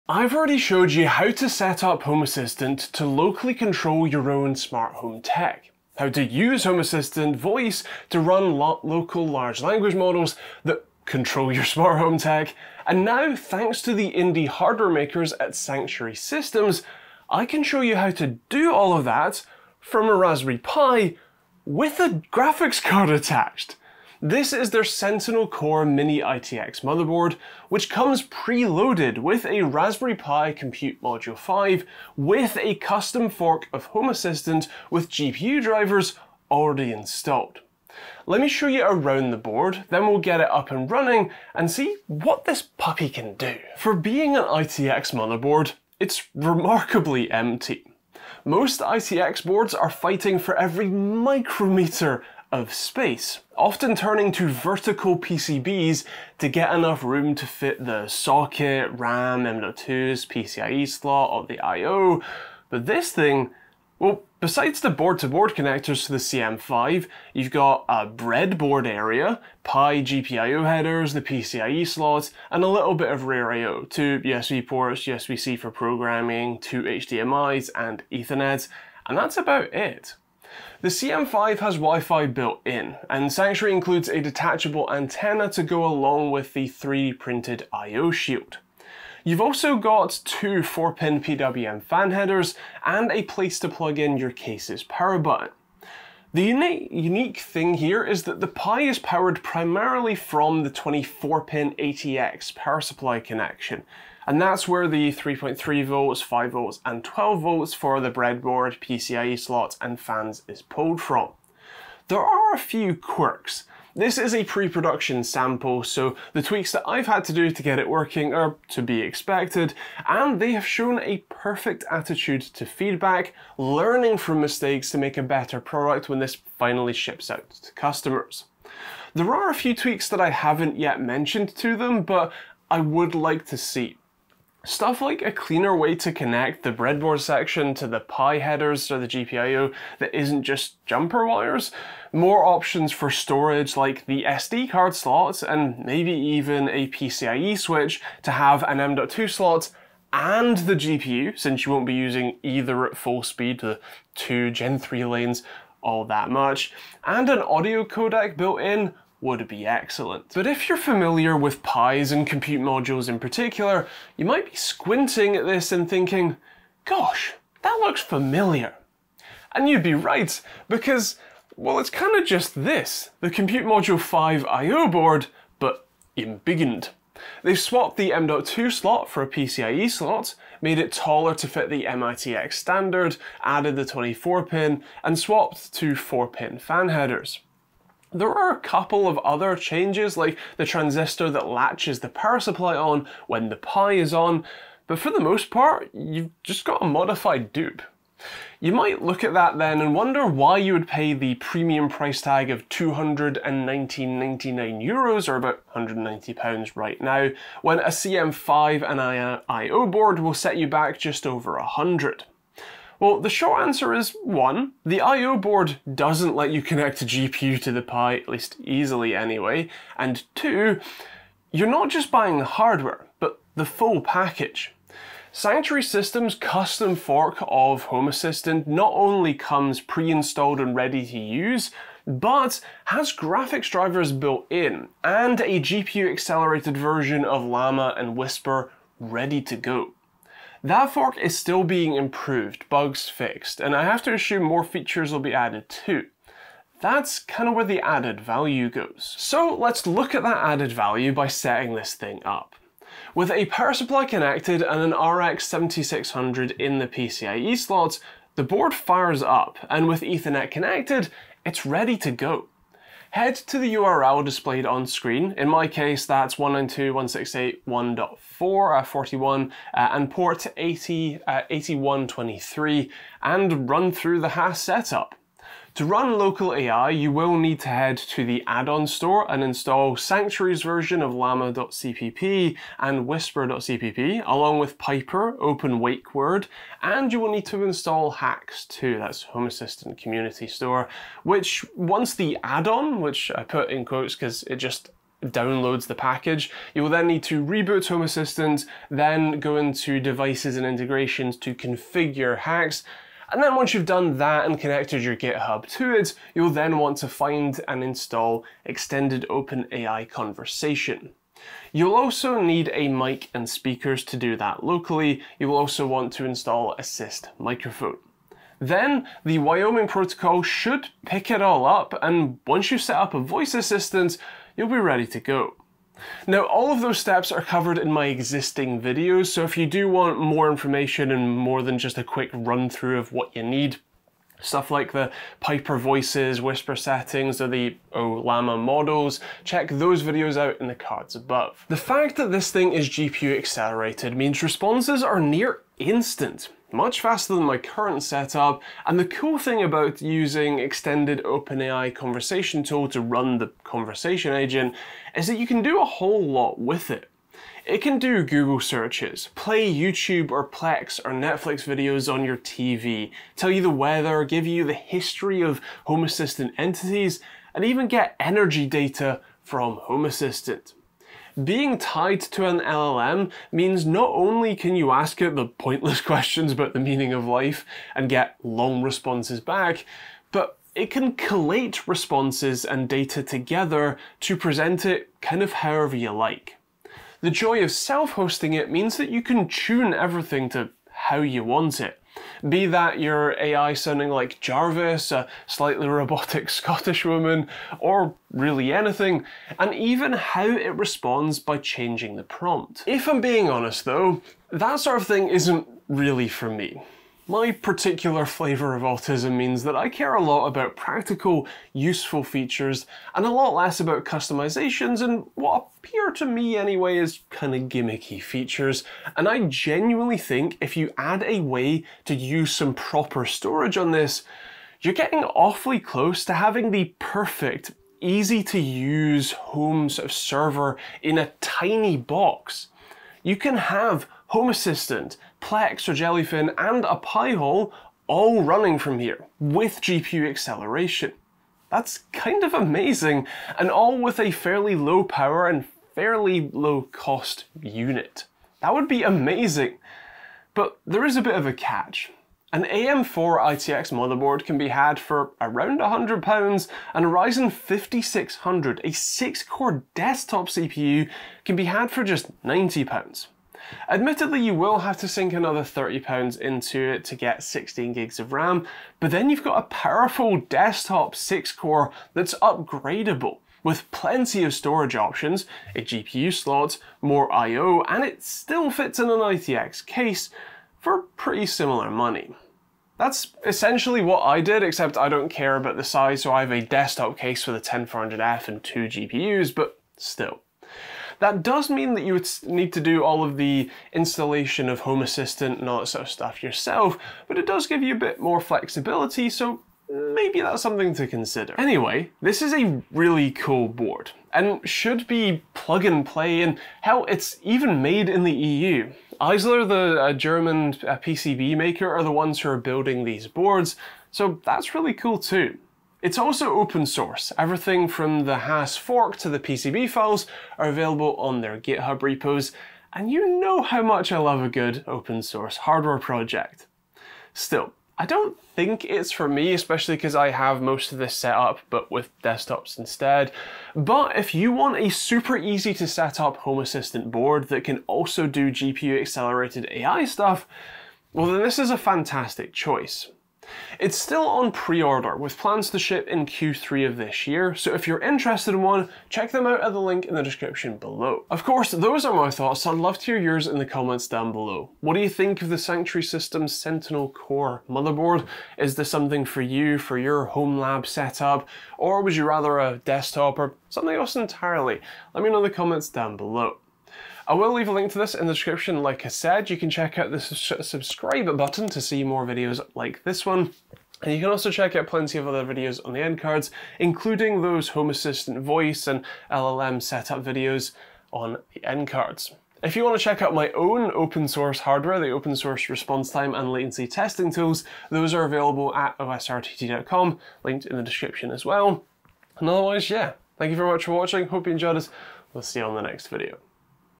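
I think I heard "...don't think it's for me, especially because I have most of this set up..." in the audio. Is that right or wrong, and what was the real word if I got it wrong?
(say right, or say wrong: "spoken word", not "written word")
right.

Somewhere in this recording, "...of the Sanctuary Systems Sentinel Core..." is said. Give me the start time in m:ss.
9:15.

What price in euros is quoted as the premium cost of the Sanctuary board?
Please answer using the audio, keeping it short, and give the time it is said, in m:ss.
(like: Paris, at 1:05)
219.99 euros, at 3:22.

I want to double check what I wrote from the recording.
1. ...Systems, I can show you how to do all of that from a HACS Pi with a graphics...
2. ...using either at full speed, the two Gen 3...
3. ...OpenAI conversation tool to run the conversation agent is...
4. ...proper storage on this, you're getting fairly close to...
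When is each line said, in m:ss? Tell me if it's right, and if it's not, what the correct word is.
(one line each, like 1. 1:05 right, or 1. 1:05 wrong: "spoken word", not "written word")
1. 0:16 wrong: "Raspberry", not "HACS"
2. 2:31 right
3. 5:51 right
4. 7:02 wrong: "awfully", not "fairly".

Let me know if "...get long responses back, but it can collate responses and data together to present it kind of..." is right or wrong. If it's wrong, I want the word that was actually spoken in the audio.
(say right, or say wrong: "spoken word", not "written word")
right.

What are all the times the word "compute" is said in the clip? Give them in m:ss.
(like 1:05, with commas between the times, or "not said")
0:30, 2:42, 2:53.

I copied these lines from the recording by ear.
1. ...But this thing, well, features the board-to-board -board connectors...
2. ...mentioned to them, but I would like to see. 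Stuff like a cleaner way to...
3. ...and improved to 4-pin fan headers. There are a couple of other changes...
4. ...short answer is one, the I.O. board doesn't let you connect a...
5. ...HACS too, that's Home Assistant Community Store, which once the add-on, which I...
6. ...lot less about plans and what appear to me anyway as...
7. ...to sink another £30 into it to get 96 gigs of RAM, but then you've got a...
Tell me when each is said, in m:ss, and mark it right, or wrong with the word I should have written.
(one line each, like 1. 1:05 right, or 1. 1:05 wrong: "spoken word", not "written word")
1. 1:02 wrong: "besides", not "features"
2. 2:11 right
3. 3:05 wrong: "swapped", not "improved"
4. 3:33 right
5. 4:48 right
6. 6:53 wrong: "customizations", not "plans"
7. 7:44 wrong: "16", not "96".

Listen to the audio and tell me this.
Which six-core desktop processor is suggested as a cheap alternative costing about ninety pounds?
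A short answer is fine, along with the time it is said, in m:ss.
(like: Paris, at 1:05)
Ryzen 5600, at 7:37.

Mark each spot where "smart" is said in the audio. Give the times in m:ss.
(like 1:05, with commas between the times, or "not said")
0:04, 0:11.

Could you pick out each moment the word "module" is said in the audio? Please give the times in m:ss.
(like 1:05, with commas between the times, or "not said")
0:31, 2:42, 2:53.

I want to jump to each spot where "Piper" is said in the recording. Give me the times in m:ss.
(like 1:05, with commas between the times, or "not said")
4:44, 5:35.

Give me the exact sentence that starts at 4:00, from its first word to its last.
That fork is still being improved, bugs fixed, and I have to assume more features will be added too.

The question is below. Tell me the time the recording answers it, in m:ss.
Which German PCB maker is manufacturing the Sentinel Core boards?
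8:29.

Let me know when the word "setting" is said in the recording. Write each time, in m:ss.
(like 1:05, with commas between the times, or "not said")
4:11, 5:36.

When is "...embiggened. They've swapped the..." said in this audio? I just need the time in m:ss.
2:56.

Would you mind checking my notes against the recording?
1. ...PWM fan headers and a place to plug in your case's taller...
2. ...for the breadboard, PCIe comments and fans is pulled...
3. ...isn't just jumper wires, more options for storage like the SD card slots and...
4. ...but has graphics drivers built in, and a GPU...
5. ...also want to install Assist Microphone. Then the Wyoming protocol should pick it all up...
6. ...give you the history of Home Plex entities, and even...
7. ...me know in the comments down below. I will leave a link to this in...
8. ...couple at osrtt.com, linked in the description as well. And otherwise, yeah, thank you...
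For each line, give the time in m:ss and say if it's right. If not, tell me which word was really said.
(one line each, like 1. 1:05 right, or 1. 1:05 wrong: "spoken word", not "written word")
1. 1:31 wrong: "power", not "taller"
2. 1:47 wrong: "slots", not "comments"
3. 2:20 right
4. 3:52 right
5. 5:15 right
6. 6:04 wrong: "Assistant", not "Plex"
7. 9:25 right
8. 9:48 wrong: "available", not "couple".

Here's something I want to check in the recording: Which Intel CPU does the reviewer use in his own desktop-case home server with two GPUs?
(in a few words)
10400F.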